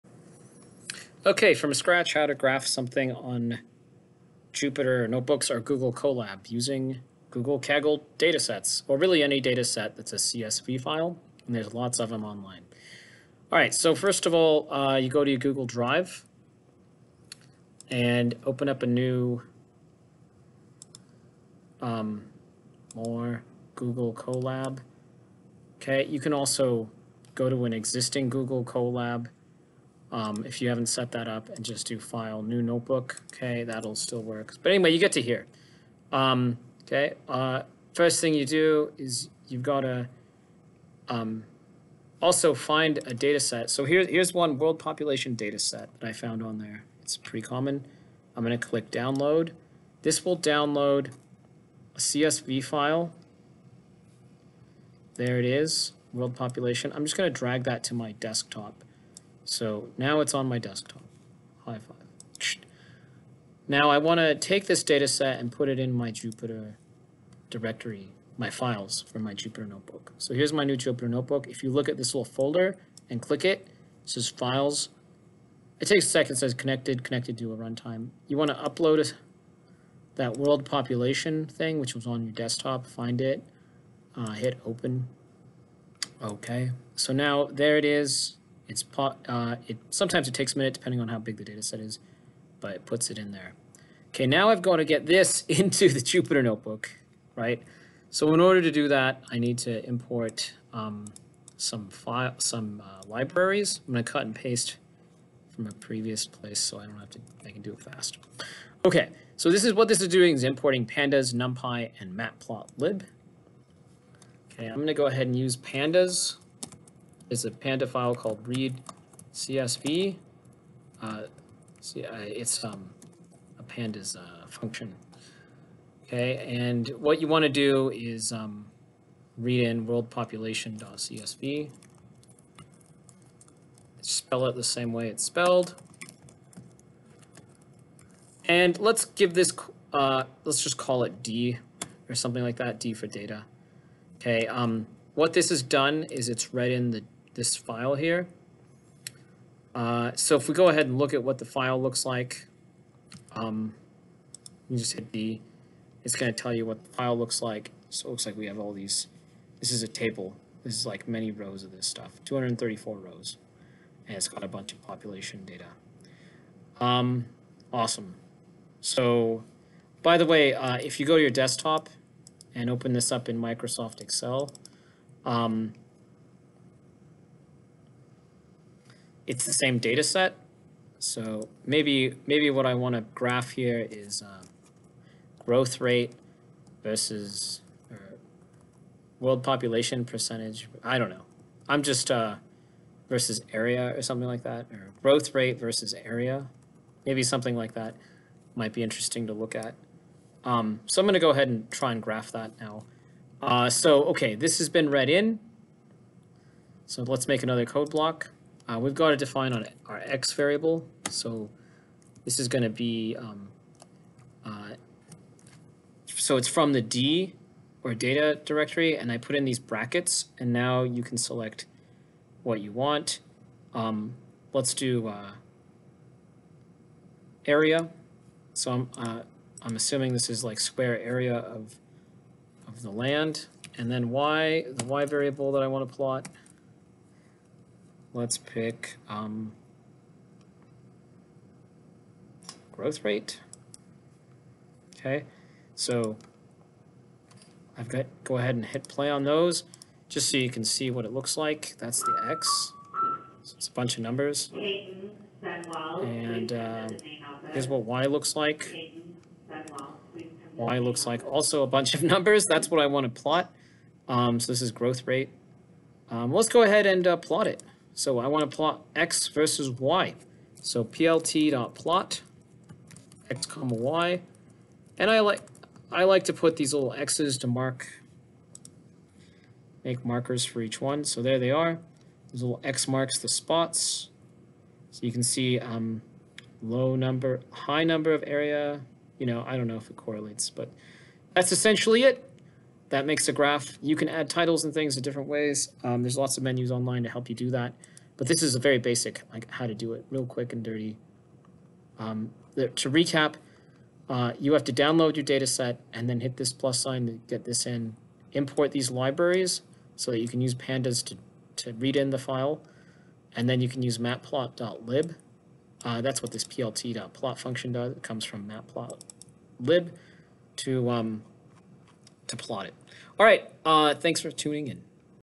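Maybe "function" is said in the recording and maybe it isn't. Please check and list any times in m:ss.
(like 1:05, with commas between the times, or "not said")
2:04, 5:17.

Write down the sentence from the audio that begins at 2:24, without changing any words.
Okay, um, what this has done is it's read in the this file here.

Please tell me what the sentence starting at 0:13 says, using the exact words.
All right, so first of all, uh, you go to your Google Drive and open up a new um, more Google Colab.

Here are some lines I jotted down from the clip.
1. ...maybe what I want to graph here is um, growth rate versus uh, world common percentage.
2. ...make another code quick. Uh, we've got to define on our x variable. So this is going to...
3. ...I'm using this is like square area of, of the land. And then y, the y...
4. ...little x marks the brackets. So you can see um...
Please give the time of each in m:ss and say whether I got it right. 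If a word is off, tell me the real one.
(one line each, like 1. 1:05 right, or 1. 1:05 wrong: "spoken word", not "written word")
1. 3:02 wrong: "population", not "common"
2. 3:27 wrong: "block", not "quick"
3. 3:49 wrong: "assuming", not "using"
4. 4:42 wrong: "spots", not "brackets".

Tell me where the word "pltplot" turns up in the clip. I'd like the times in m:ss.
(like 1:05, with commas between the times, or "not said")
4:30, 5:16.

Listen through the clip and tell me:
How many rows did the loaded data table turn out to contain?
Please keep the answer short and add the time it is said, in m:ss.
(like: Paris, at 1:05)
234, at 2:42.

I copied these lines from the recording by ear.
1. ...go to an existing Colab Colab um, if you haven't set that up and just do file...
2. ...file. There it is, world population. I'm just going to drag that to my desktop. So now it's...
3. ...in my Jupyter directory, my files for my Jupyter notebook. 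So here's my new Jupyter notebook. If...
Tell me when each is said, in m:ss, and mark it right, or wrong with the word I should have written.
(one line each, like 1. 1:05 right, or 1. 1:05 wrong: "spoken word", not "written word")
1. 0:27 wrong: "Google", not "Colab"
2. 0:52 right
3. 1:05 right.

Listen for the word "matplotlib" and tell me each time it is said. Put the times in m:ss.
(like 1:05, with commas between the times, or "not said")
1:52, 5:13, 5:18.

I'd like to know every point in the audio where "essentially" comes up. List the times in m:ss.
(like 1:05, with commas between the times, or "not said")
4:51.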